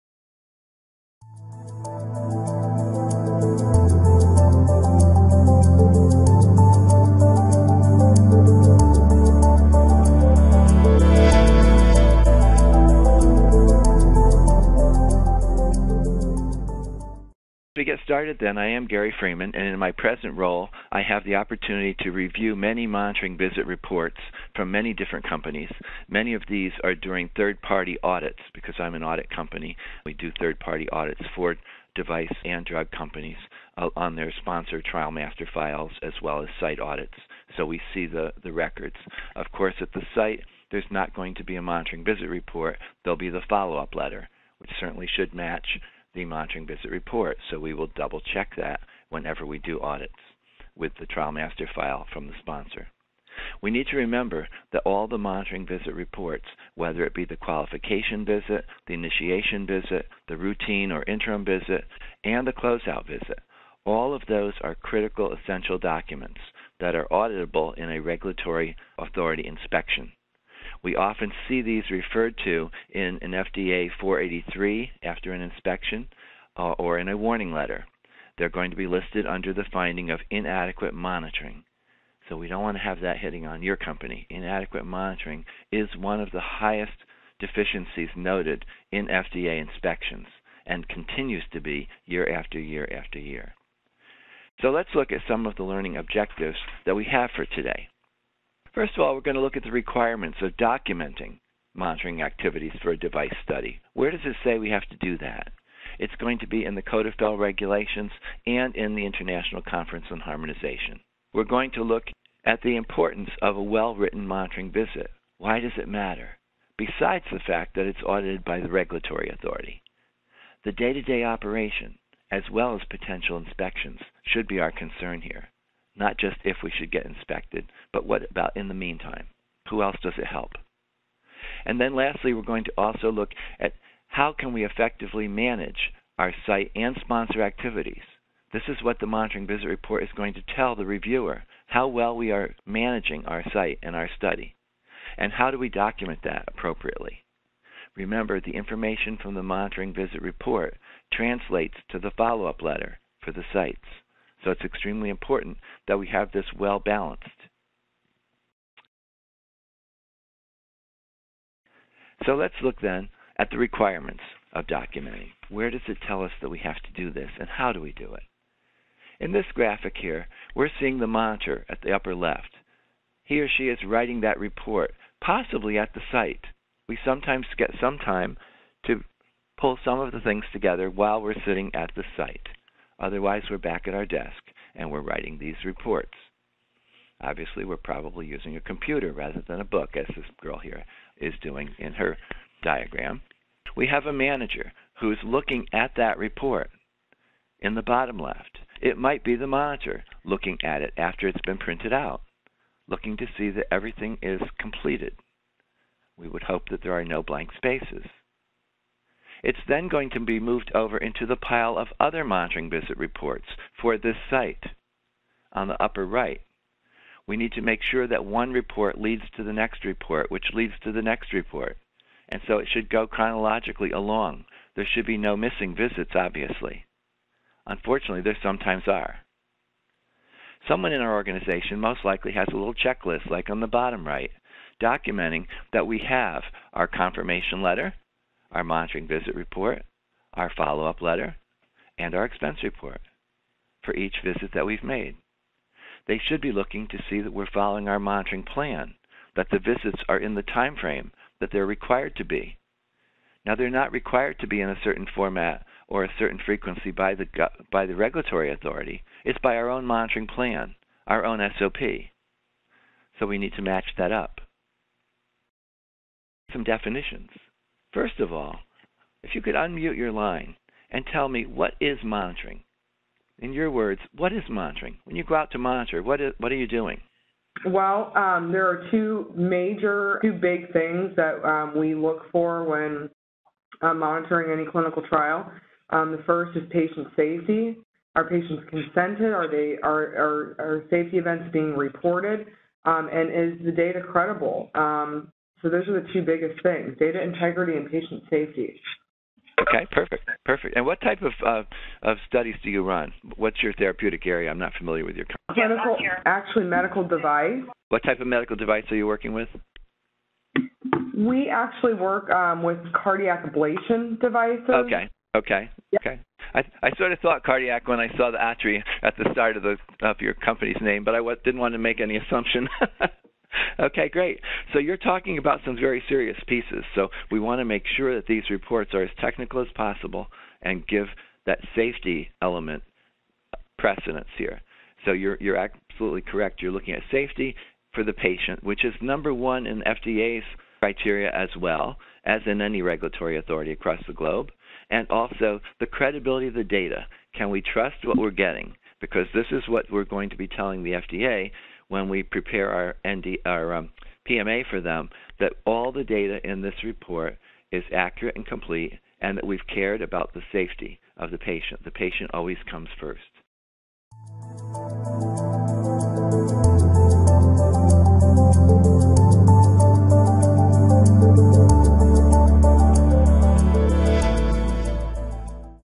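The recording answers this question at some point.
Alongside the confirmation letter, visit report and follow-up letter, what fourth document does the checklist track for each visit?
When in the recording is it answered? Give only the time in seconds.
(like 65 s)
242 s.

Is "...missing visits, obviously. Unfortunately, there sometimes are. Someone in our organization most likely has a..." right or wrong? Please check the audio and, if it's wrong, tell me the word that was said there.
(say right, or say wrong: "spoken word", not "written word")
right.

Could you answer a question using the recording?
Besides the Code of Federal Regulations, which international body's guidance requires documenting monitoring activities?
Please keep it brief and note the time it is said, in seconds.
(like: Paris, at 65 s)
International Conference on Harmonization, at 109 s.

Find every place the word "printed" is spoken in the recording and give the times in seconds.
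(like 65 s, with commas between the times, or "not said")
201 s.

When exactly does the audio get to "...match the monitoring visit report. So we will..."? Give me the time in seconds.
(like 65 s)
45 s.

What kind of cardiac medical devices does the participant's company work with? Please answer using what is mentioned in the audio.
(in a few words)
Cardiac ablation devices.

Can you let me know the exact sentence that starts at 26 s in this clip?
Many of these are during third party audits because I'm an audit company.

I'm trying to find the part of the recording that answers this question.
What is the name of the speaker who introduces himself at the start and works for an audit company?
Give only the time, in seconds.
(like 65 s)
18 s.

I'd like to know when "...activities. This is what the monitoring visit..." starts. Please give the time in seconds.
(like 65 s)
137 s.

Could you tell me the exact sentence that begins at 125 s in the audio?
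Not just if we should get inspected, but what about in the meantime?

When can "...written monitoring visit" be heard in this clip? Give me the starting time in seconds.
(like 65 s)
113 s.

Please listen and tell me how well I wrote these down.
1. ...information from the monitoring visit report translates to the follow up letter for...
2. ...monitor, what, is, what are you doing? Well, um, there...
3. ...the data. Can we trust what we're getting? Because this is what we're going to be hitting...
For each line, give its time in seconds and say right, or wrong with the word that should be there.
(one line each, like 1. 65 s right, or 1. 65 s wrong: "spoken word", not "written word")
1. 148 s right
2. 275 s right
3. 346 s wrong: "telling", not "hitting".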